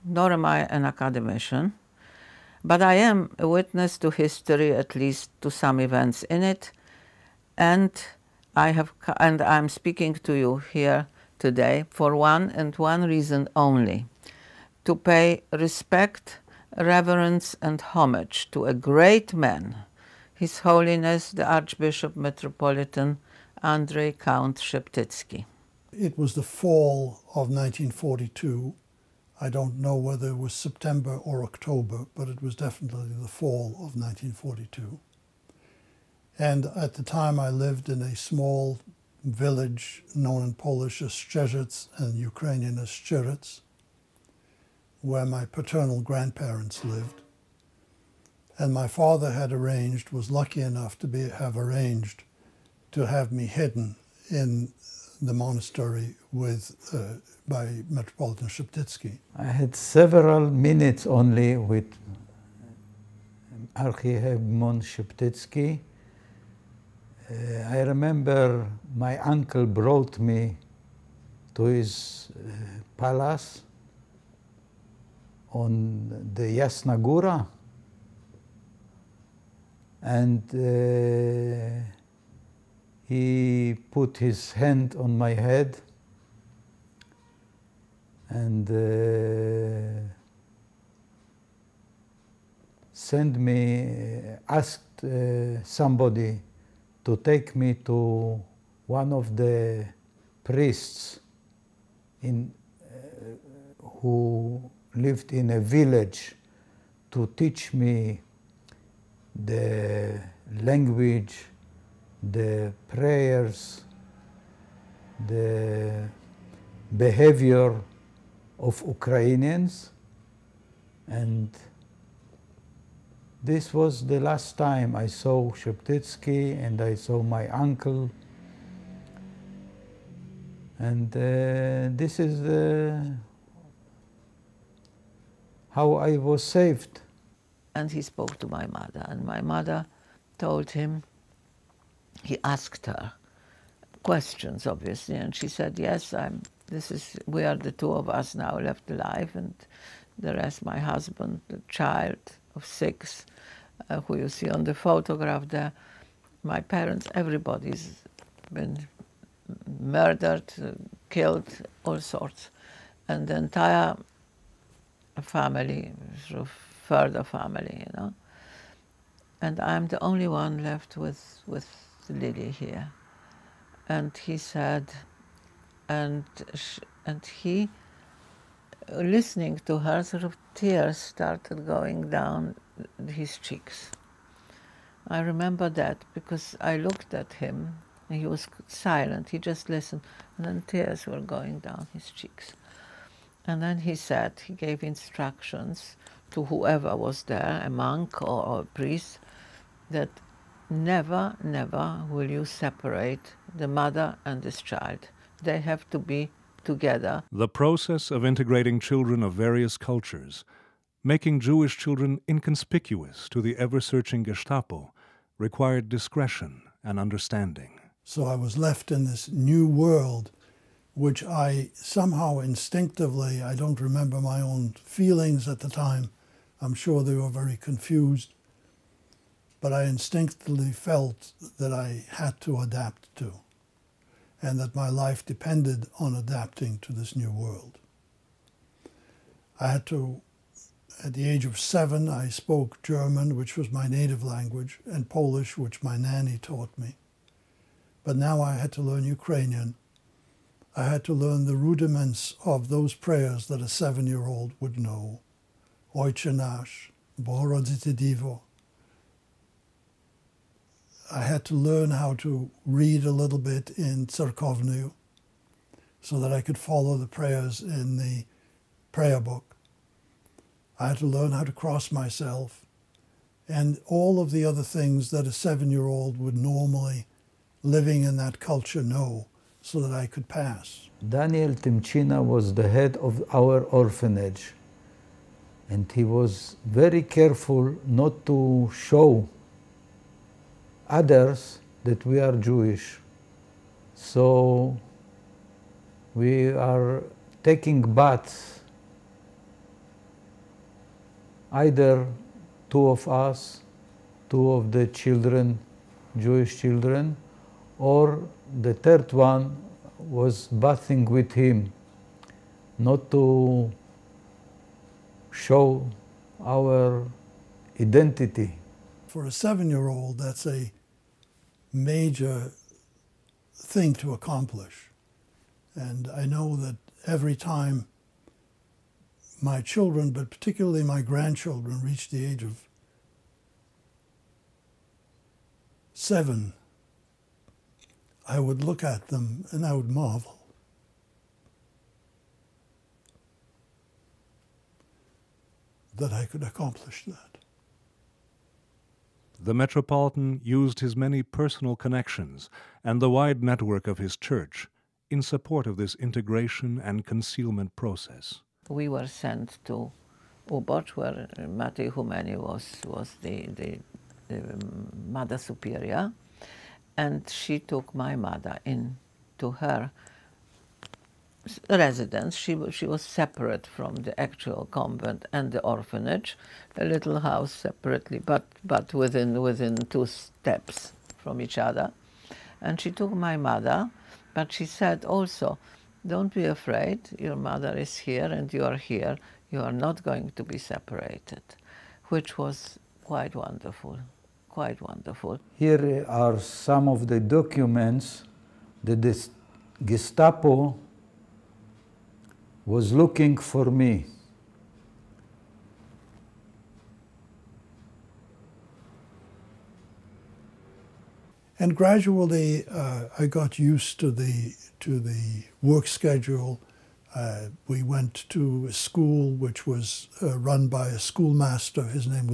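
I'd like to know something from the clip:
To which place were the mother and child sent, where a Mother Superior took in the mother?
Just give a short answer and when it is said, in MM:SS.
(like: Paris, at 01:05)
Ubod, at 06:00.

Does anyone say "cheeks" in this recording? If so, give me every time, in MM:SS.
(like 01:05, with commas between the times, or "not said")
03:03, 03:12.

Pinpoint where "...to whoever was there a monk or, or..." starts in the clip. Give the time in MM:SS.
03:16.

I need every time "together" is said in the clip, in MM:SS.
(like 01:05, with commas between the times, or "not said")
03:26.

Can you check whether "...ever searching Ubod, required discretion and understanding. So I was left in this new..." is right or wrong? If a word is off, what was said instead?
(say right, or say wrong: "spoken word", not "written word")
wrong: "Gestapo", not "Ubod".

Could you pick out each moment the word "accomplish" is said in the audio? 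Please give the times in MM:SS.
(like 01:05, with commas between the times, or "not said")
05:24, 05:46.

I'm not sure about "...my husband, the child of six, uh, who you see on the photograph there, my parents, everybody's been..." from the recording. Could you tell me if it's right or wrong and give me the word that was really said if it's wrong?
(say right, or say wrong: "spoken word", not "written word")
right.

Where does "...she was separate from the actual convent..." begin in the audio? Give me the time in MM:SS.
06:12.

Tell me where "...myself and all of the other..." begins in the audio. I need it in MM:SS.
04:31.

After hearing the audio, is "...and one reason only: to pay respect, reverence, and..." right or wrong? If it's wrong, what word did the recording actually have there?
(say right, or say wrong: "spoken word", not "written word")
right.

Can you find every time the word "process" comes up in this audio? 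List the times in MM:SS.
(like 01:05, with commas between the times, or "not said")
03:27, 05:57.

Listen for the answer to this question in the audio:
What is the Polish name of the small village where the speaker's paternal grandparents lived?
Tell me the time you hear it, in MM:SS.
00:41.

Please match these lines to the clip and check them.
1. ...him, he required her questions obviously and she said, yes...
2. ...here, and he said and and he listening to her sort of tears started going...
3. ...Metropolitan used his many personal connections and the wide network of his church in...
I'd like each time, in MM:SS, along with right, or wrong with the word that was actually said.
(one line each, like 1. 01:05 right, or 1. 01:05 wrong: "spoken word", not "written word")
1. 02:20 wrong: "asked", not "required"
2. 02:52 right
3. 05:49 right.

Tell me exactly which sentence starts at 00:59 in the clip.
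I had several minutes only with Archihebmon Sheptytsky.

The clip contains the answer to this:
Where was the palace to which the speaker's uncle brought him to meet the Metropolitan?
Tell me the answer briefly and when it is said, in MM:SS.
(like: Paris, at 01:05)
Yasnagura, at 01:16.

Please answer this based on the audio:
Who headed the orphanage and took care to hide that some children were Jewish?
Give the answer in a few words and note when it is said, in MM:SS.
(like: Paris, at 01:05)
Daniel Temchina, at 04:41.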